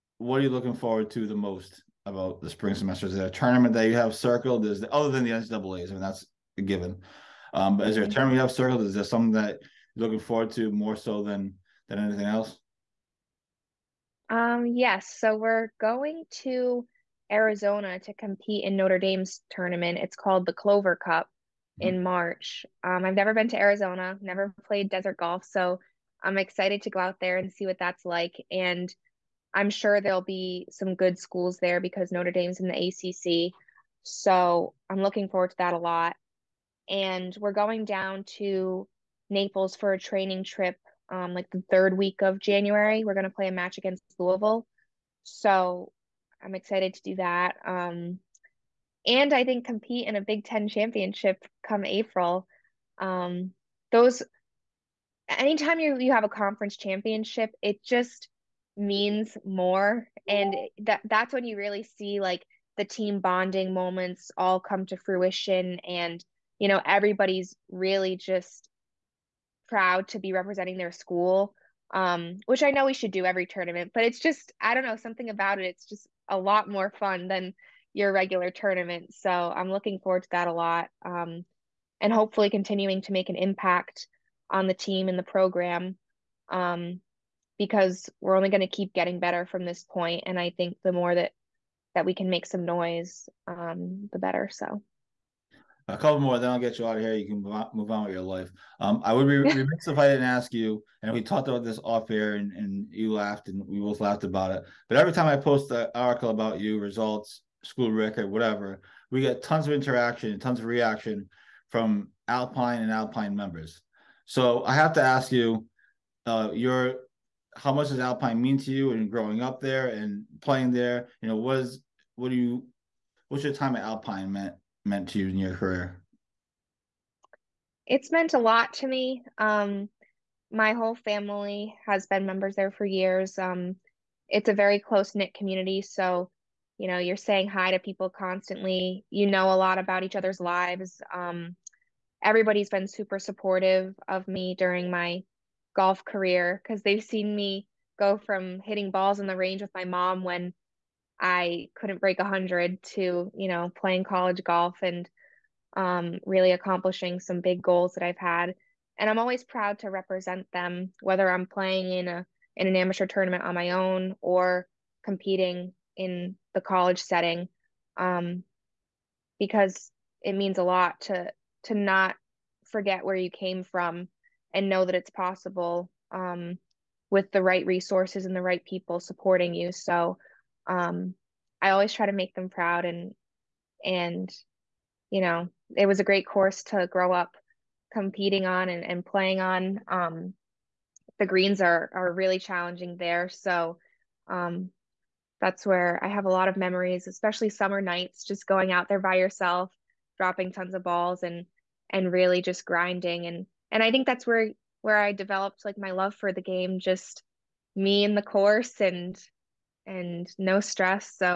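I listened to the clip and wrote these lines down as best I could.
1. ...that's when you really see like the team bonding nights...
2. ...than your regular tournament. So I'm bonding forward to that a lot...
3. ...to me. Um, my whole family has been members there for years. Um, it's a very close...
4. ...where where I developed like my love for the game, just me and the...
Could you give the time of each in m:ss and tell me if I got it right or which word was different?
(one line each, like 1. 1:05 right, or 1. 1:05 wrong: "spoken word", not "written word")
1. 1:01 wrong: "moments", not "nights"
2. 1:17 wrong: "looking", not "bonding"
3. 2:08 right
4. 3:24 right.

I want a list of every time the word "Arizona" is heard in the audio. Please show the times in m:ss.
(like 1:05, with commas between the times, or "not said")
0:17, 0:23.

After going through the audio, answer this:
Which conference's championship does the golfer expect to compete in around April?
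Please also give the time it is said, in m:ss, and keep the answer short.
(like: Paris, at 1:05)
Big Ten, at 0:50.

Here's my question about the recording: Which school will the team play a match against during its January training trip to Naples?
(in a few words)
Louisville.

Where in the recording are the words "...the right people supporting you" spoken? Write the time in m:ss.
2:58.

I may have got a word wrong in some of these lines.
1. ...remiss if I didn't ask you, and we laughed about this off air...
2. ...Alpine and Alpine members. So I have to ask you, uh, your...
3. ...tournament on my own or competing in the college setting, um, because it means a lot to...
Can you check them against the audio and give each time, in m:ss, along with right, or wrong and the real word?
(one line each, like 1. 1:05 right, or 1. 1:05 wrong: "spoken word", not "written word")
1. 1:39 wrong: "talked", not "laughed"
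2. 1:52 right
3. 2:43 right.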